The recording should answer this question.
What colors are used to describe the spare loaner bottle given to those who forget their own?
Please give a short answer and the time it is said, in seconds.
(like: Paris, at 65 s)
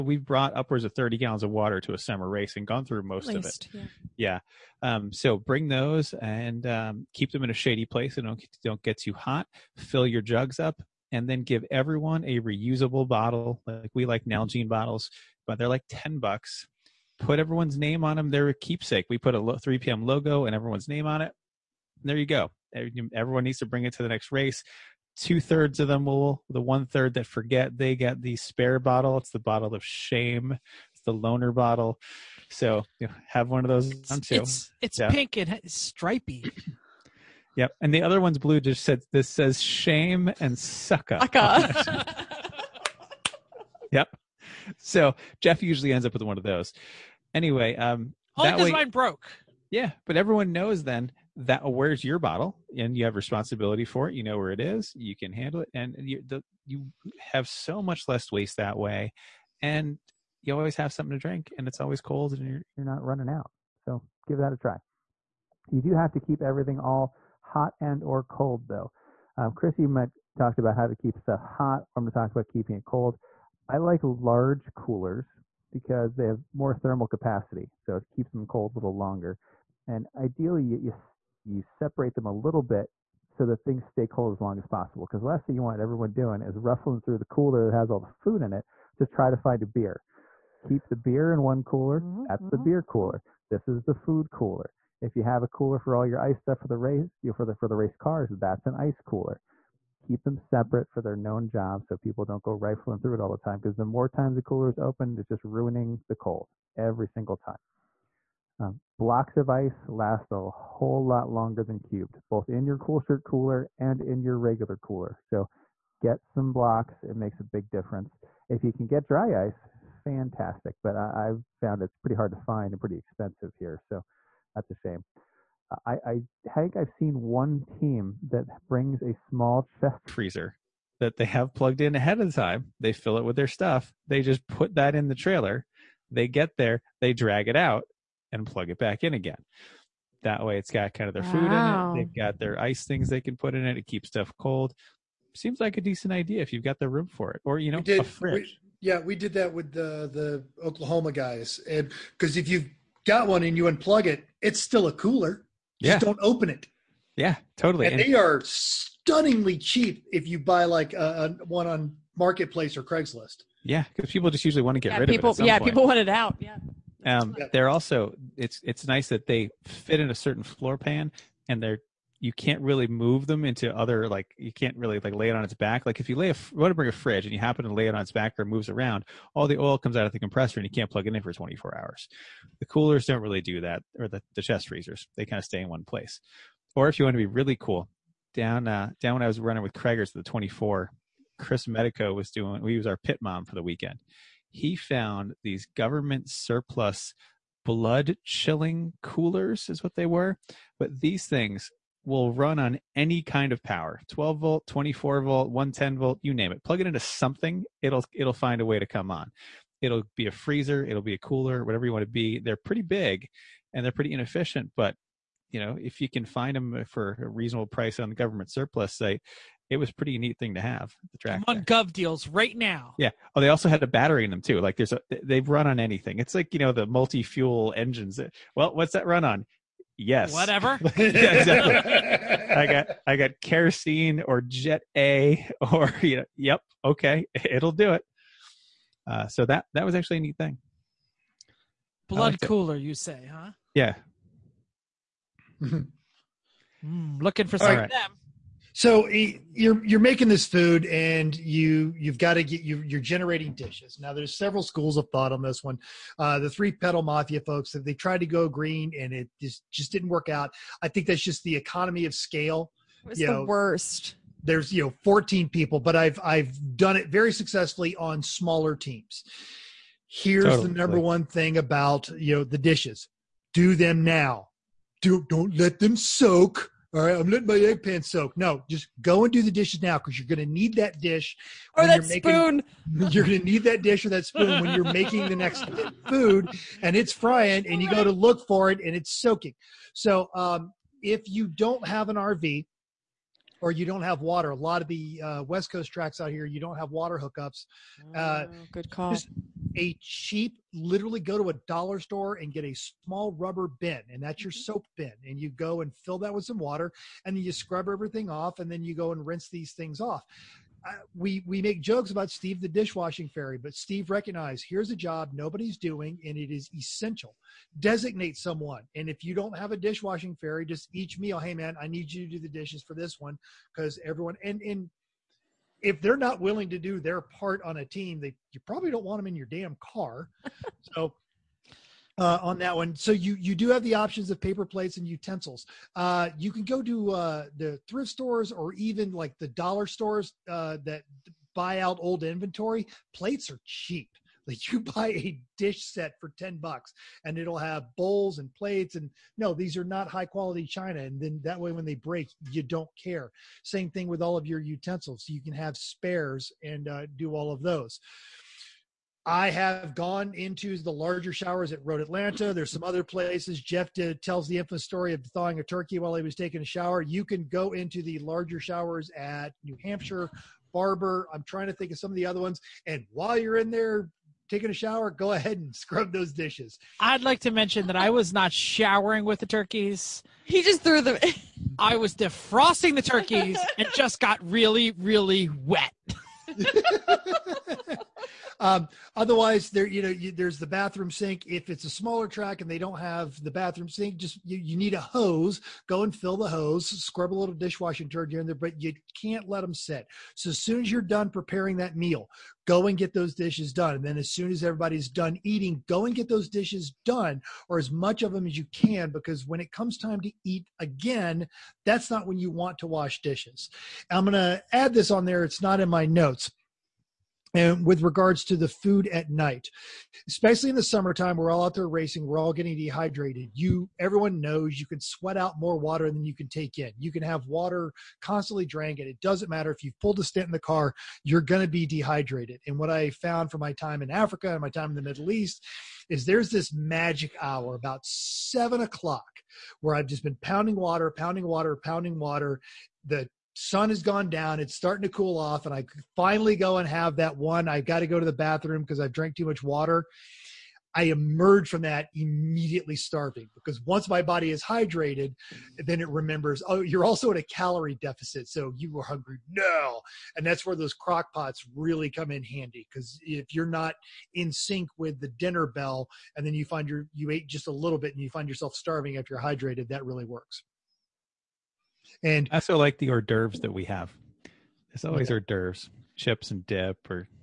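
pink and stripy, at 35 s.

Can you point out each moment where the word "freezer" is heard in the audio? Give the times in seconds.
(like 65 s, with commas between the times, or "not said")
130 s, 184 s, 210 s.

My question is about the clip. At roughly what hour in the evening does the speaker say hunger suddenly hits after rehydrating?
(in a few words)
7 o'clock.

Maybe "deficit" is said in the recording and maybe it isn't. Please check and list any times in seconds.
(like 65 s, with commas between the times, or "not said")
458 s.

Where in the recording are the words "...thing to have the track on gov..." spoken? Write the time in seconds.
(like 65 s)
220 s.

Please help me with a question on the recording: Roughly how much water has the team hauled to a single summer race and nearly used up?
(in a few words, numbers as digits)
30 gallons.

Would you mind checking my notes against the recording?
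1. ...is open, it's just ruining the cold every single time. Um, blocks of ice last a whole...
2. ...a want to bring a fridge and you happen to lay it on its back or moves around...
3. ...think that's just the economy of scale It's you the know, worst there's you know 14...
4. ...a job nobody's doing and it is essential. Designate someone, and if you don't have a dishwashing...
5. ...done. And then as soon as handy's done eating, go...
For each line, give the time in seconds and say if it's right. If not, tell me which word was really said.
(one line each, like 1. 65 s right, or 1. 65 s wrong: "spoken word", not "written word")
1. 104 s right
2. 176 s right
3. 260 s right
4. 314 s right
5. 403 s wrong: "everybody", not "handy".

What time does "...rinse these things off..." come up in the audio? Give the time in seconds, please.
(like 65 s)
309 s.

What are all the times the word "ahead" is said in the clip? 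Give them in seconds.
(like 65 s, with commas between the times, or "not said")
131 s, 375 s.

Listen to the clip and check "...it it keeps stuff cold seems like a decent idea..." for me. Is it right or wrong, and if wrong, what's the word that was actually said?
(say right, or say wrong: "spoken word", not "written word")
right.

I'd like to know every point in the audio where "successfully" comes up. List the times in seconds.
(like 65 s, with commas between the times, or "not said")
267 s.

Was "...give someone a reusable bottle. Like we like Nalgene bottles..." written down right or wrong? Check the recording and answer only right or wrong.
wrong.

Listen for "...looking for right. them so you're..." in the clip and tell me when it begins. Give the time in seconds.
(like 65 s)
247 s.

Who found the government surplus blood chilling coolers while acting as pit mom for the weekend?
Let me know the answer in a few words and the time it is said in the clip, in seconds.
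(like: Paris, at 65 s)
Chris Medico, at 191 s.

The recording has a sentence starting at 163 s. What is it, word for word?
Yeah, because people just usually want to get yeah, rid people, of it.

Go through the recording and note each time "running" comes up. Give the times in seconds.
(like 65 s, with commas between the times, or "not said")
63 s, 189 s.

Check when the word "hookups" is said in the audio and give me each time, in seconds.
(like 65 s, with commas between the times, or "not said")
297 s.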